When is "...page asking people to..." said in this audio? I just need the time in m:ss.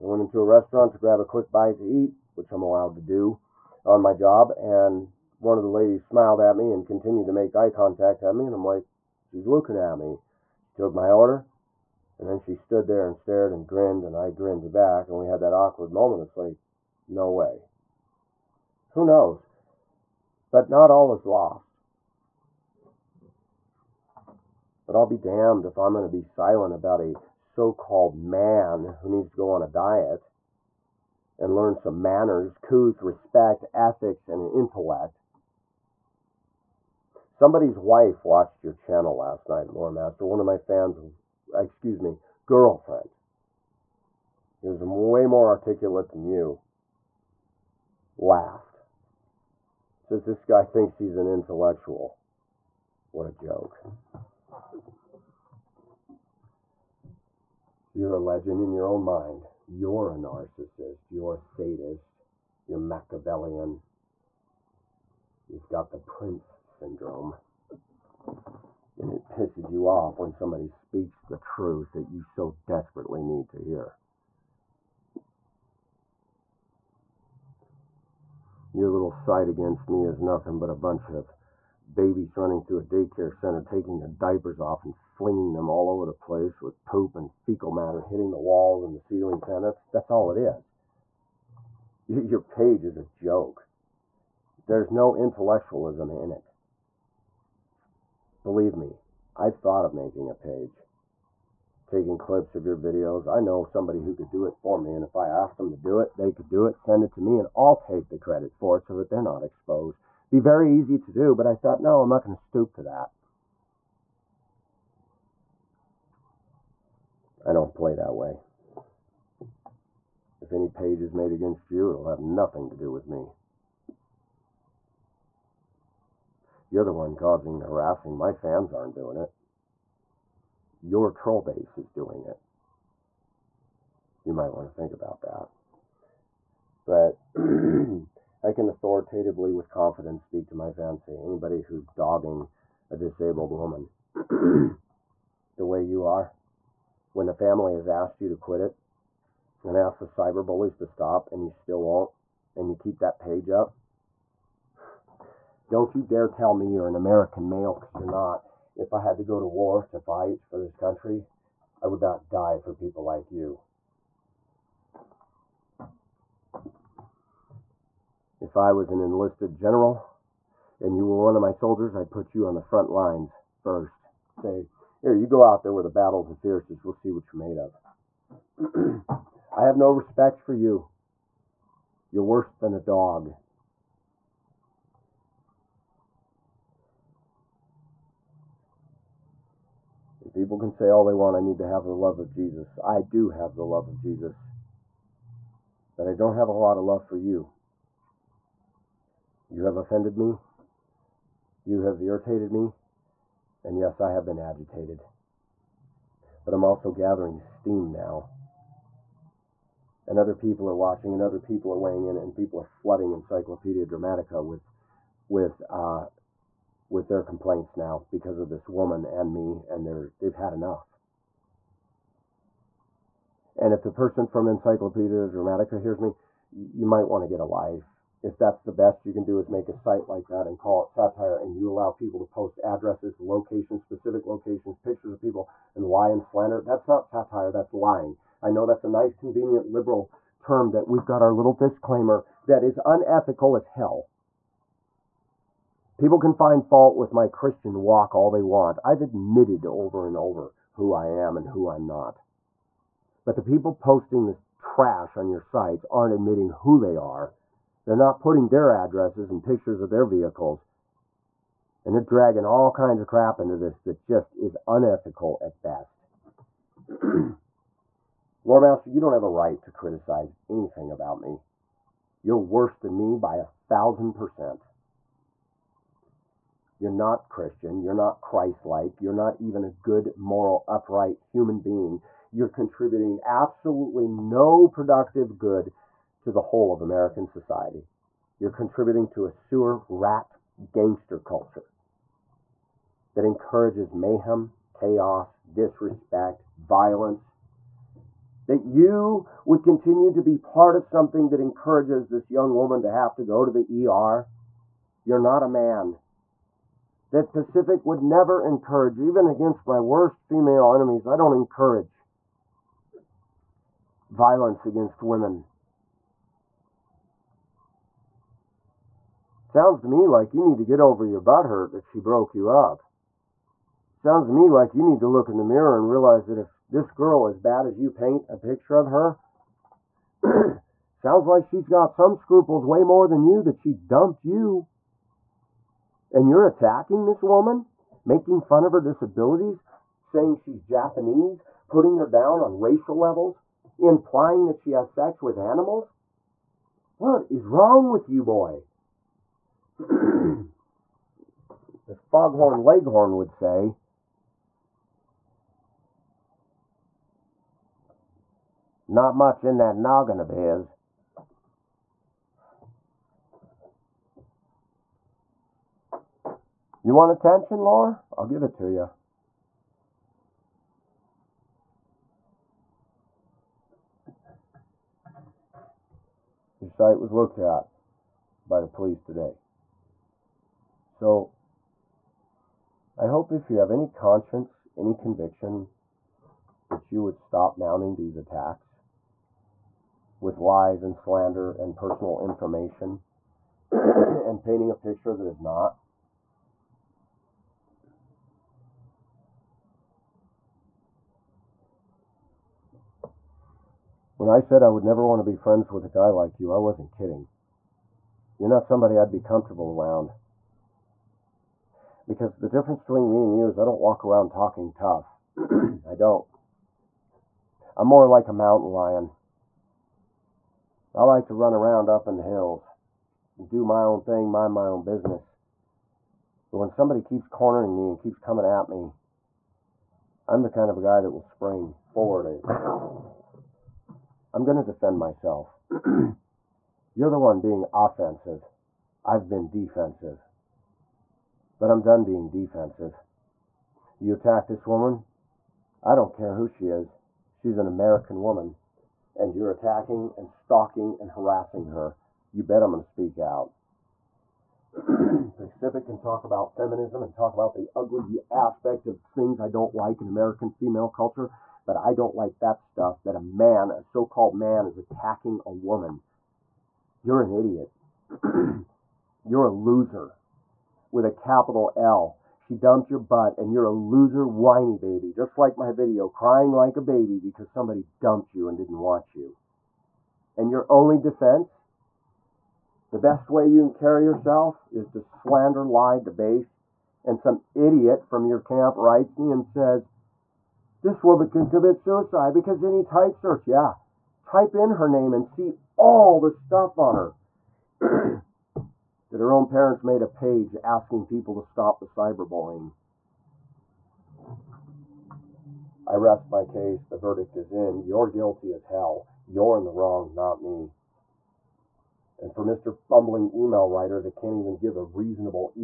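8:20.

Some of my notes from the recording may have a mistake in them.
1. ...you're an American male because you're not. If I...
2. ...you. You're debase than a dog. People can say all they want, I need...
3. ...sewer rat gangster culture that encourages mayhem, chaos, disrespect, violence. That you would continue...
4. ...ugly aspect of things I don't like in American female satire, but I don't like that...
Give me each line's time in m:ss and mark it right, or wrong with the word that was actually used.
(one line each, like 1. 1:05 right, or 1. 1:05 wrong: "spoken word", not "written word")
1. 2:36 right
2. 3:00 wrong: "worse", not "debase"
3. 4:49 right
4. 7:37 wrong: "culture", not "satire".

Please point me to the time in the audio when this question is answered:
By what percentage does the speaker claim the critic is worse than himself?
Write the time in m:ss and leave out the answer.
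4:33.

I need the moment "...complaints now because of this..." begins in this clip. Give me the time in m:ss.
3:37.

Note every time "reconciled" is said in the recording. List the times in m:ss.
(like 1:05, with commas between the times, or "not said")
not said.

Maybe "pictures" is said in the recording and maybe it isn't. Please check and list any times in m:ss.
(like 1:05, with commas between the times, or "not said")
3:54, 4:19, 5:28, 6:34.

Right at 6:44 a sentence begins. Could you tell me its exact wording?
When I said I would never want to be friends with a guy like you, I wasn't kidding.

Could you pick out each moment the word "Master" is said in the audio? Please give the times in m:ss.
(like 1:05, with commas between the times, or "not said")
0:39, 4:28.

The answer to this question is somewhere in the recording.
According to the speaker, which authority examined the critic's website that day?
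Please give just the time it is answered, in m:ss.
6:18.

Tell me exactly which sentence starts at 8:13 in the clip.
Yeah, type in her name and see all the stuff on her.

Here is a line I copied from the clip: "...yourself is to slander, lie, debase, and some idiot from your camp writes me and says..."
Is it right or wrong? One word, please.
right.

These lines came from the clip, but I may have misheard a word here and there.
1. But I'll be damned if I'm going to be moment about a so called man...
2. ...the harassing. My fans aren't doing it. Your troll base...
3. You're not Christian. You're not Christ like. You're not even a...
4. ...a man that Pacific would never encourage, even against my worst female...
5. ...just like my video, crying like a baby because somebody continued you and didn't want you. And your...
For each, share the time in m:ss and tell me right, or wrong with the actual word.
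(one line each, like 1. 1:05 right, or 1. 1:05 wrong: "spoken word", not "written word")
1. 0:24 wrong: "silent", not "moment"
2. 2:07 right
3. 4:36 right
4. 5:05 right
5. 7:55 wrong: "dumped", not "continued".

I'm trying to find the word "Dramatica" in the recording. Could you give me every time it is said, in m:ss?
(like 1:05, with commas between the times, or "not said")
3:33, 3:45.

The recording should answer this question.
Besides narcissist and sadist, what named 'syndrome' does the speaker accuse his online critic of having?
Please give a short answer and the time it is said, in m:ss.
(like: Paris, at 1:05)
the prince syndrome, at 1:05.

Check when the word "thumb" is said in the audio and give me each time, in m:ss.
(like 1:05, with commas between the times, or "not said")
not said.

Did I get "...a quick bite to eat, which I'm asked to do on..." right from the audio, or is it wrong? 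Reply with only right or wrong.
wrong.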